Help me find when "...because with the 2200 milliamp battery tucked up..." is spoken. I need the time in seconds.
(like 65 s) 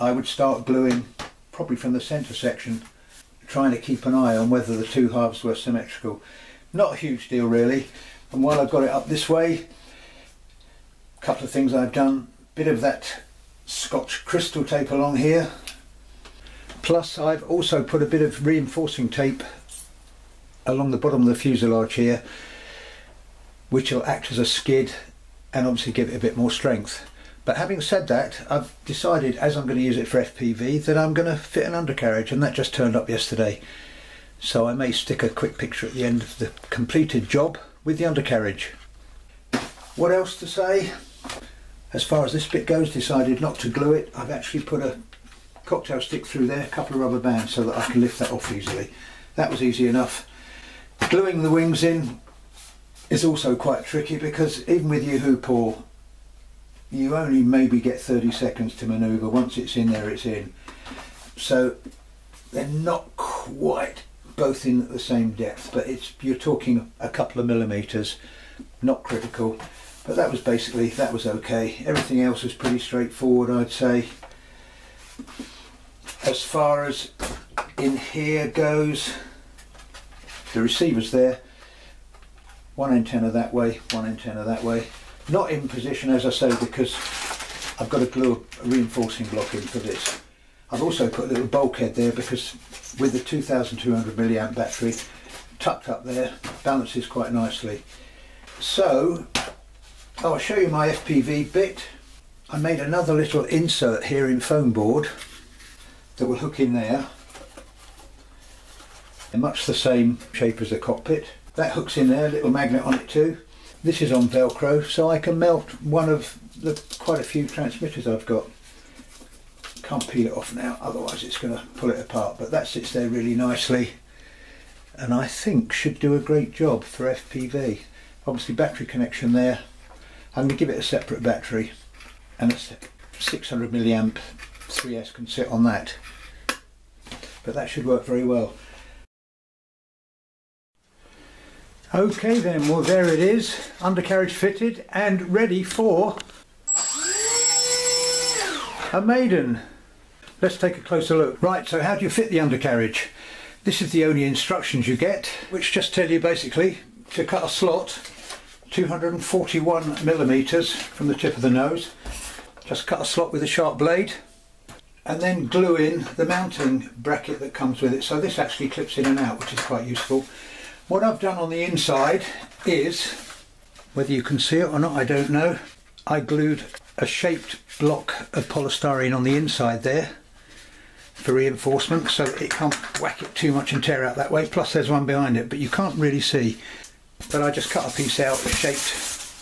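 92 s.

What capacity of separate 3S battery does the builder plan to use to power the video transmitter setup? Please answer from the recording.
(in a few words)
600 milliamp.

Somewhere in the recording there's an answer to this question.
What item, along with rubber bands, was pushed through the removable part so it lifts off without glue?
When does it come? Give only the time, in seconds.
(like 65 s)
45 s.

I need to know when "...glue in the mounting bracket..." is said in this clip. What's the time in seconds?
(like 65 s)
165 s.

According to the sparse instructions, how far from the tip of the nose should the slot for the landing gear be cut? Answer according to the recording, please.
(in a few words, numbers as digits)
241 millimetres.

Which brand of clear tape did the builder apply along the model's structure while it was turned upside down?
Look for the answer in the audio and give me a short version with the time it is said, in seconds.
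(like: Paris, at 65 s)
Scotch crystal tape, at 13 s.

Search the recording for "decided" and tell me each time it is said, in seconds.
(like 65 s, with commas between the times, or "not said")
28 s, 42 s.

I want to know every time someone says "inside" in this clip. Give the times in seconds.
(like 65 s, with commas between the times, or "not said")
171 s, 179 s.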